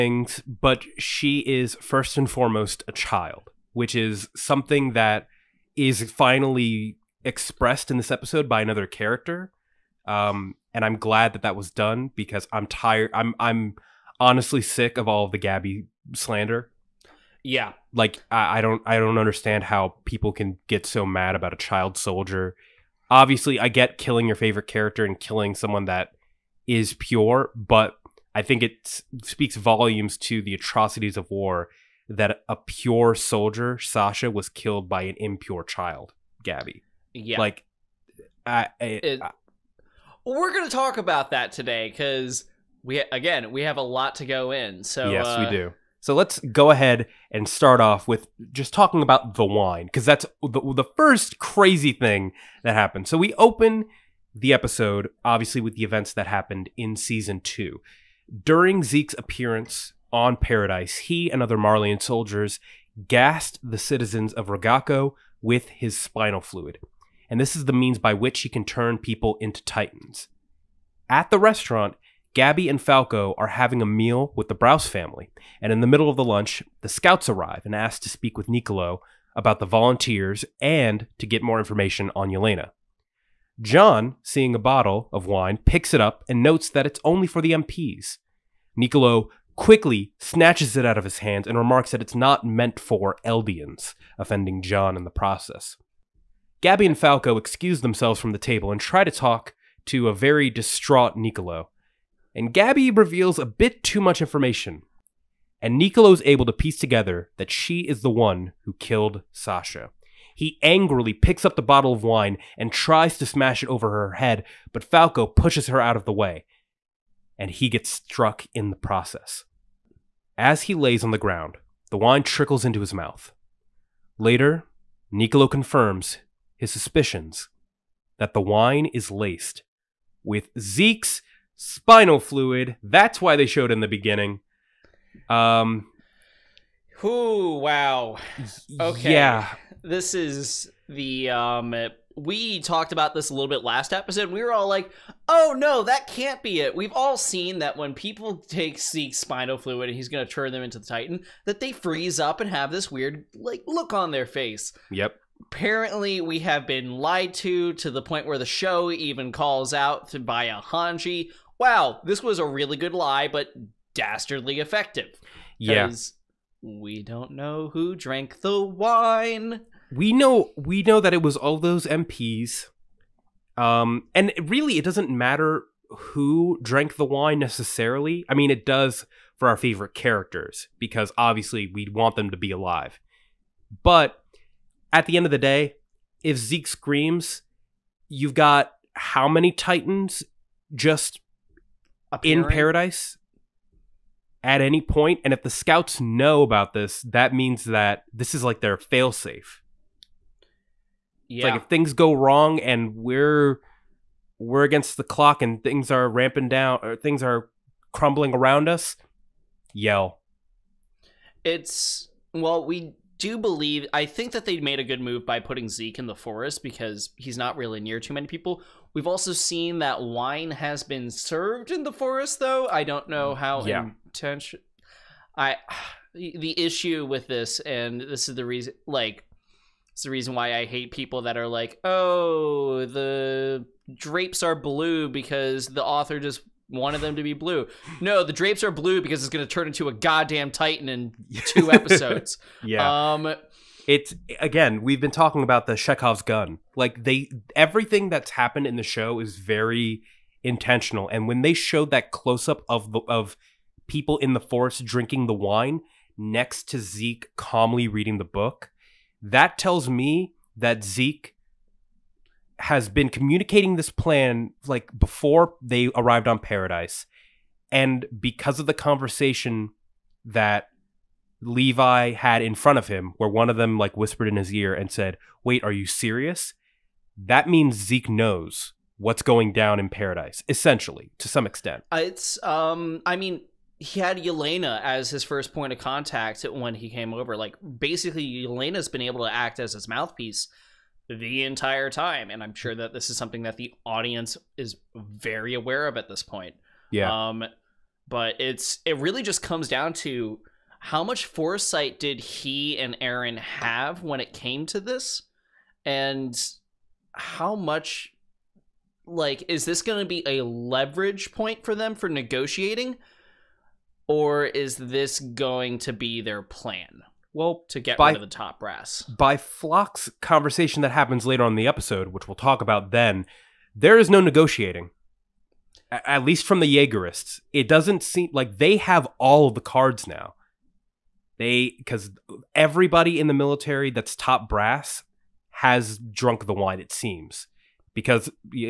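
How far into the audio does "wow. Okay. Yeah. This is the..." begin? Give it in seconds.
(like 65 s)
137 s.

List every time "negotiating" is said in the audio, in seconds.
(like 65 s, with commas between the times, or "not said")
312 s, 324 s.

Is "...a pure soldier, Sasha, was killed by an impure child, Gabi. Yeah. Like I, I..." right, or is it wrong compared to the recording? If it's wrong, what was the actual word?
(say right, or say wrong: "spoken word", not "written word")
right.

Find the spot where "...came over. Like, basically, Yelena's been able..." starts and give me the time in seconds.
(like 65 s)
286 s.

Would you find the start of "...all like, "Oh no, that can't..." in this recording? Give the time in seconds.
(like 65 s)
144 s.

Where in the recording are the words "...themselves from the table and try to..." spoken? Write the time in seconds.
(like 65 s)
97 s.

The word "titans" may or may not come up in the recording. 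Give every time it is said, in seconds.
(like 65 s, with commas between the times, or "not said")
69 s, 150 s, 189 s, 240 s.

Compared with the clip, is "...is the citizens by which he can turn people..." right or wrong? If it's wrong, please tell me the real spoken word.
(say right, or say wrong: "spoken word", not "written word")
wrong: "means", not "citizens".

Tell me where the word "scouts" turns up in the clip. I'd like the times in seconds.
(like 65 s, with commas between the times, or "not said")
76 s, 195 s.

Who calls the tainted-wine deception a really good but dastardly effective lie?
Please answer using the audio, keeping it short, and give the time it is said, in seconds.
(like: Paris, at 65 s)
Hanji, at 160 s.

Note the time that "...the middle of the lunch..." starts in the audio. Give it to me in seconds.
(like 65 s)
75 s.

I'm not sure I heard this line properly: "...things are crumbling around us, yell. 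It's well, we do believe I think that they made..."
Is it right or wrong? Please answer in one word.
right.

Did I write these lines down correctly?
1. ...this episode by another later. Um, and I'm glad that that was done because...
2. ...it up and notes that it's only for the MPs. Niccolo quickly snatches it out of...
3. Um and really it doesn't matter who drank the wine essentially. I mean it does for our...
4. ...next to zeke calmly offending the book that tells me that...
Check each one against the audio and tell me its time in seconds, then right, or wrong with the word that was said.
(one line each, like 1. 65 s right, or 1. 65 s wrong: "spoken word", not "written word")
1. 7 s wrong: "character", not "later"
2. 85 s right
3. 173 s wrong: "necessarily", not "essentially"
4. 256 s wrong: "reading", not "offending".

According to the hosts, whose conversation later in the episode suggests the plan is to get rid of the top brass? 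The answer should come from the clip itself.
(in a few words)
Floch.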